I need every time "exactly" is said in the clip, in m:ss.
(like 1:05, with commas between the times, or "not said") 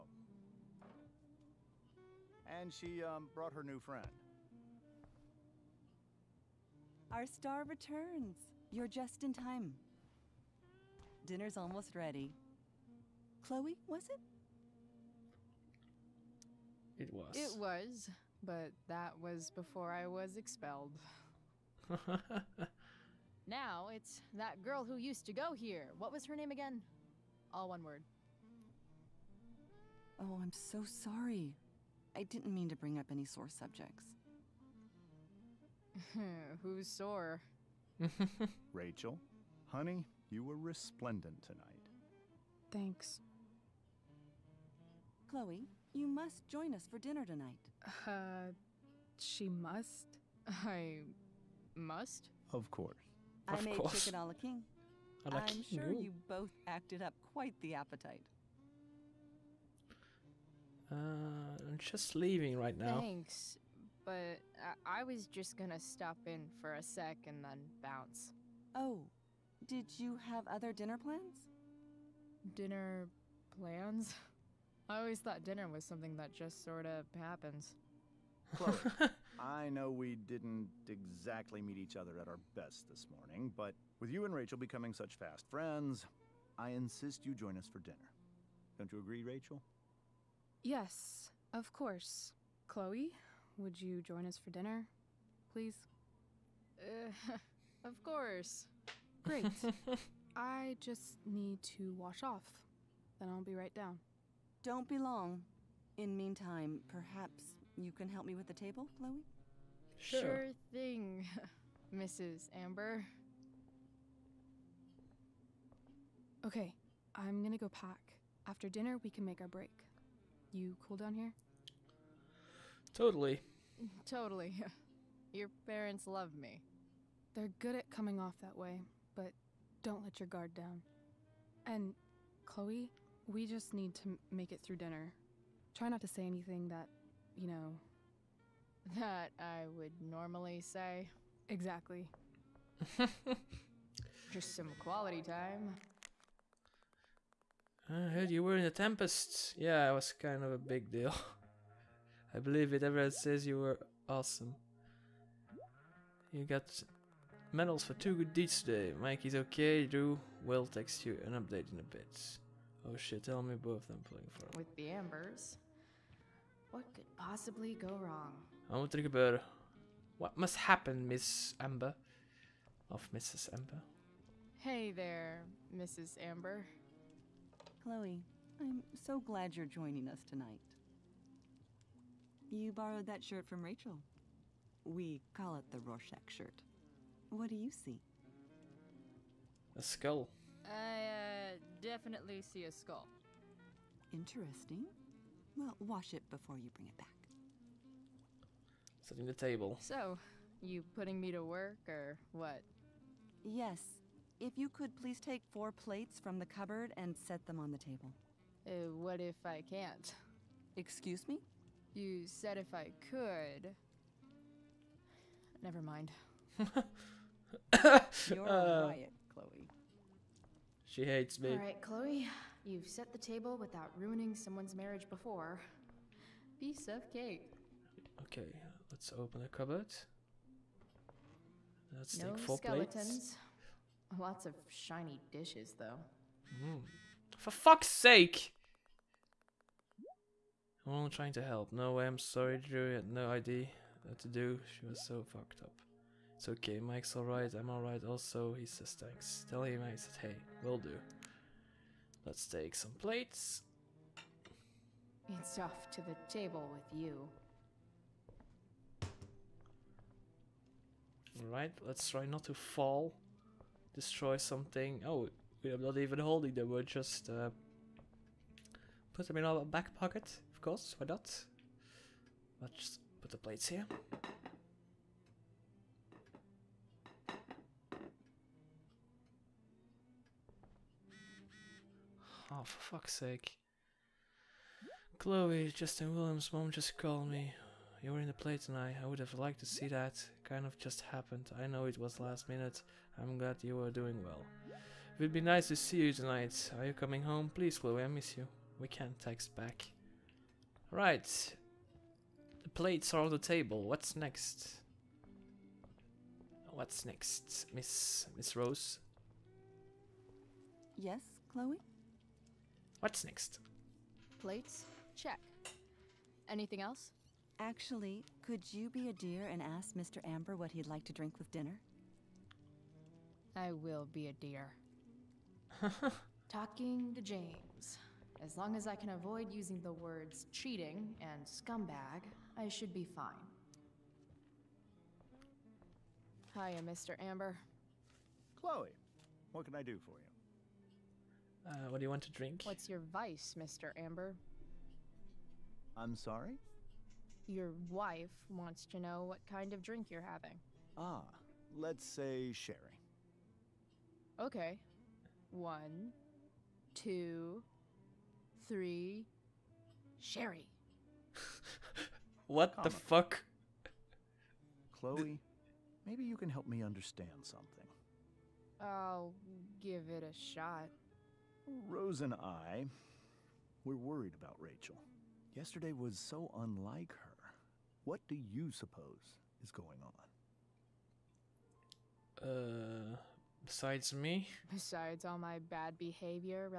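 1:20, 2:21.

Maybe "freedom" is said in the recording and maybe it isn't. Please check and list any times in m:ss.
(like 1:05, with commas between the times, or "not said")
not said.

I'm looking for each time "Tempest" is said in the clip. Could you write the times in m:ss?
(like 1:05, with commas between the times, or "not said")
2:28.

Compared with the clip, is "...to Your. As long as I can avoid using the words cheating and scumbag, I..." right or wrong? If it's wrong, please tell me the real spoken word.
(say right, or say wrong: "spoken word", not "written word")
wrong: "James", not "Your".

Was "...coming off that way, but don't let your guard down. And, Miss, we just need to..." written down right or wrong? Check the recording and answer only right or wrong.
wrong.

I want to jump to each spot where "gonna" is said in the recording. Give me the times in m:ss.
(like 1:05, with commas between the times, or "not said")
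1:05, 1:57.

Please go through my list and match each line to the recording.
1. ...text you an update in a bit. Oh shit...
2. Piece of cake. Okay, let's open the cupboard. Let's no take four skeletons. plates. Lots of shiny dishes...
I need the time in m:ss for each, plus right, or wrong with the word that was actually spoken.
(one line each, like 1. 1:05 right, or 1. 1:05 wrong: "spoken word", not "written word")
1. 2:40 right
2. 3:46 right.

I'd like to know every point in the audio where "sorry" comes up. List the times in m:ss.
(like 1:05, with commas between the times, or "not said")
0:30, 4:02, 5:46.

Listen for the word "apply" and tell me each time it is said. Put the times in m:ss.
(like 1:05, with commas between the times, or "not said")
not said.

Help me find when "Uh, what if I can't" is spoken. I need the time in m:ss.
3:28.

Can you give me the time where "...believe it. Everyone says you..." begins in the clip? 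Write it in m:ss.
2:32.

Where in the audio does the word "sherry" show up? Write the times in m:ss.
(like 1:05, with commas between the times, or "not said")
5:52, 6:00.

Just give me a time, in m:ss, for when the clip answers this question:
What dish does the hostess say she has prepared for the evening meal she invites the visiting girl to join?
0:54.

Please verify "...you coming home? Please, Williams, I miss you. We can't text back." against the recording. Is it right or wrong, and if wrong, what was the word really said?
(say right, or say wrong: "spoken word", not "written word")
wrong: "Chloe", not "Williams".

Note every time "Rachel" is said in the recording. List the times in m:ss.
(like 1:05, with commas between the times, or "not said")
0:38, 1:24, 1:29, 3:03, 6:14.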